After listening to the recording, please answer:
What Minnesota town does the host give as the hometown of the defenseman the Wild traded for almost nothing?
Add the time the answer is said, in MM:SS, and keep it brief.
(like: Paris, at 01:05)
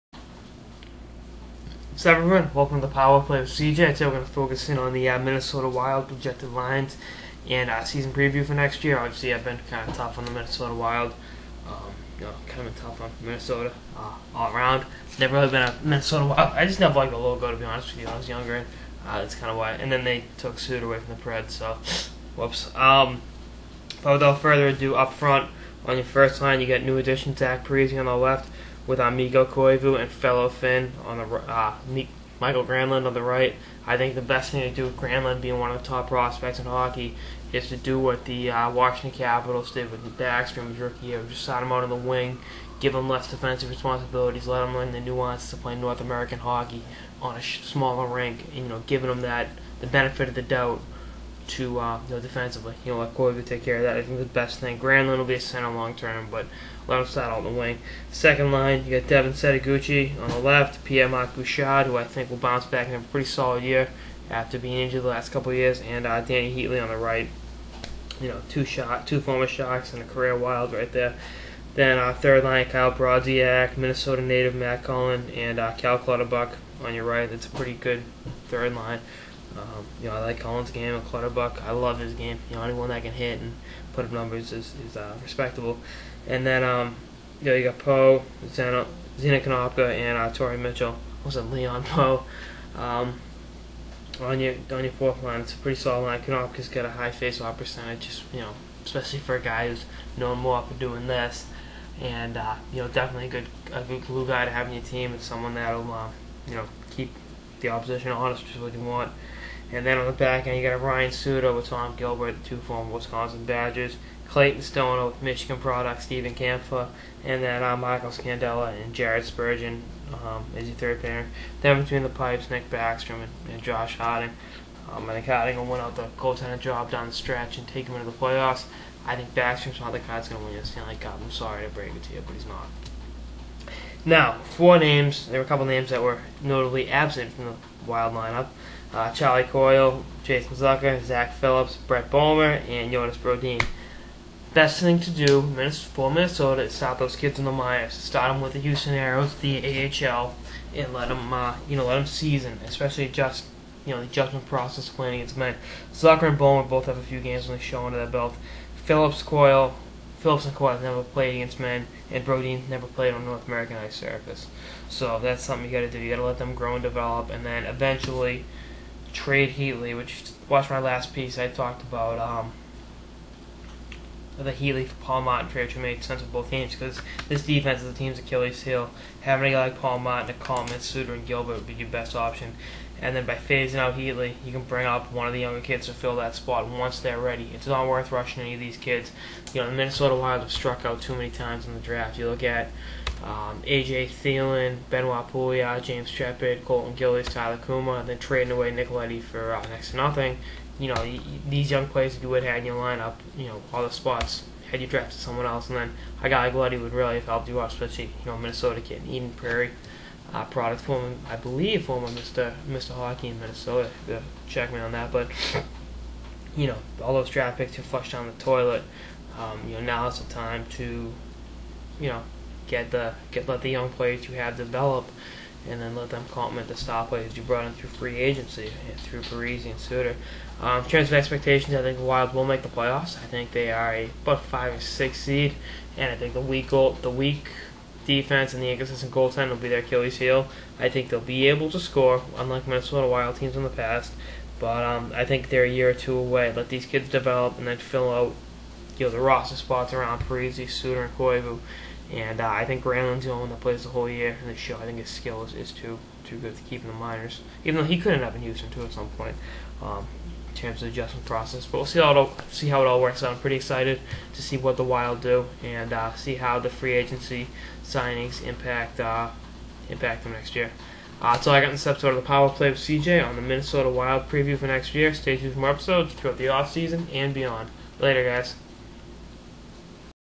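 Eden Prairie, at 03:29.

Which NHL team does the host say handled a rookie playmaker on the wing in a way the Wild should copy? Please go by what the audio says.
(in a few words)
Washington Capitals.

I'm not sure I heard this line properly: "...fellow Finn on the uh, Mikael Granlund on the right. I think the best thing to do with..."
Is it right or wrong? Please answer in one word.
right.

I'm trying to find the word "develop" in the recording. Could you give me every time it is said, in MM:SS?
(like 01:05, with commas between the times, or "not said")
02:46, 03:44, 04:07.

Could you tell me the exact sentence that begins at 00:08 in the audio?
Obviously, I've been kind of tough on the Minnesota Wild.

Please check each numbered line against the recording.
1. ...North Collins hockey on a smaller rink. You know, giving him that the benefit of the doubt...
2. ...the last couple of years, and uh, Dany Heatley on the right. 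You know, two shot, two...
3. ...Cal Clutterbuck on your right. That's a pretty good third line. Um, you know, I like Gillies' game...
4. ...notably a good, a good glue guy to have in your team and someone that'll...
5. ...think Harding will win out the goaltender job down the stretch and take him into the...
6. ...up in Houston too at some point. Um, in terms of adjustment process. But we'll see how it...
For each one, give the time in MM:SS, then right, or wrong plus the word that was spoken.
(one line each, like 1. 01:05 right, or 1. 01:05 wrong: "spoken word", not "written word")
1. 00:45 wrong: "American", not "Collins"
2. 01:05 right
3. 01:15 wrong: "Collins", not "Gillies"
4. 01:42 wrong: "definitely", not "notably"
5. 02:05 right
6. 04:18 right.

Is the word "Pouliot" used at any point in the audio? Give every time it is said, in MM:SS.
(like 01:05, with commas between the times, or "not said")
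03:15.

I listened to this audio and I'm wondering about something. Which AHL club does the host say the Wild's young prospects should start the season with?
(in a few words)
Houston Aeros.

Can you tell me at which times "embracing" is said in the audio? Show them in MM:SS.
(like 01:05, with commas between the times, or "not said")
not said.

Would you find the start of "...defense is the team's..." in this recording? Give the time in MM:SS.
02:57.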